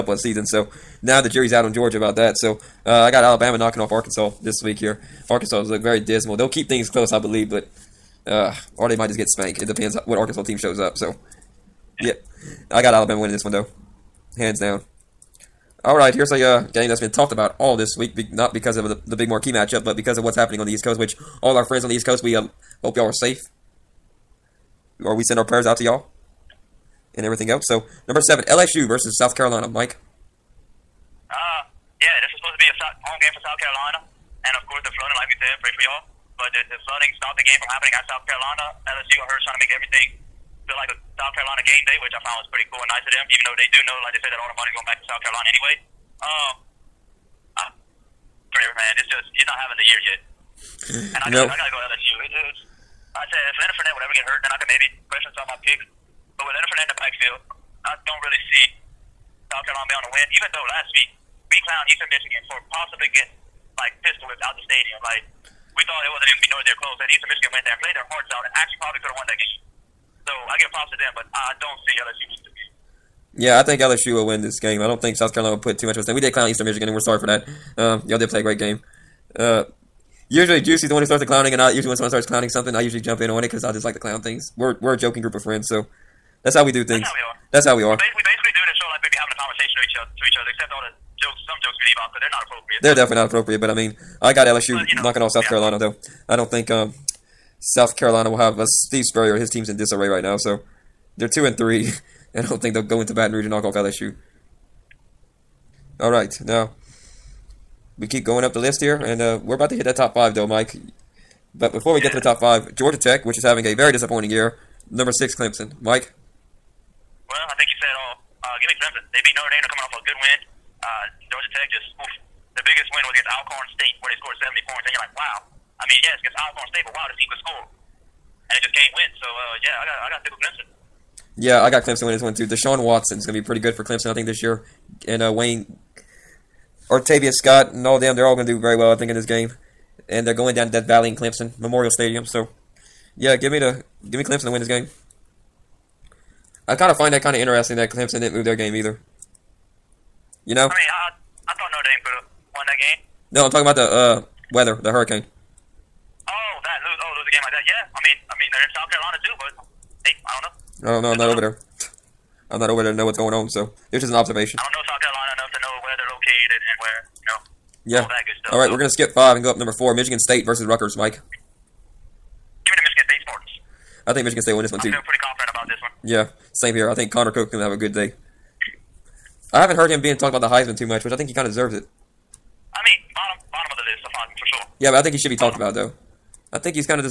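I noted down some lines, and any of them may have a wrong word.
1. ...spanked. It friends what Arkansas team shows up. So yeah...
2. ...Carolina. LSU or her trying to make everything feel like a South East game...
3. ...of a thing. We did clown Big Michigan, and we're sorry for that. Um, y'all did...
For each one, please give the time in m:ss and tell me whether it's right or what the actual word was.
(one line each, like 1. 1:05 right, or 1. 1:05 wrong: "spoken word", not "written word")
1. 0:09 wrong: "depends", not "friends"
2. 0:38 wrong: "Carolina", not "East"
3. 1:15 wrong: "Eastern", not "Big".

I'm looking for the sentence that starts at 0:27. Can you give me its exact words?
So, number seven, LSU versus South Carolina, Mike.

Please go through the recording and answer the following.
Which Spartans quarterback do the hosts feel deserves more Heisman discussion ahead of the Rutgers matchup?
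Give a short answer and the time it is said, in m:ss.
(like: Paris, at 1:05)
Connor Cook, at 2:57.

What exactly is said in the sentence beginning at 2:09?
So uh, yeah, I got I got to go Clemson.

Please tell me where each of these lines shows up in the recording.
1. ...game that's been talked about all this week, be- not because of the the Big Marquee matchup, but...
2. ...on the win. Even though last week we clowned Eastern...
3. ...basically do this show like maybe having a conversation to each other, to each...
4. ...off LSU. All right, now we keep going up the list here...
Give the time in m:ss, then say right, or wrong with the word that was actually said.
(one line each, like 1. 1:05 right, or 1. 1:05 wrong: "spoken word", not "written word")
1. 0:16 right
2. 0:59 right
3. 1:28 right
4. 1:43 right.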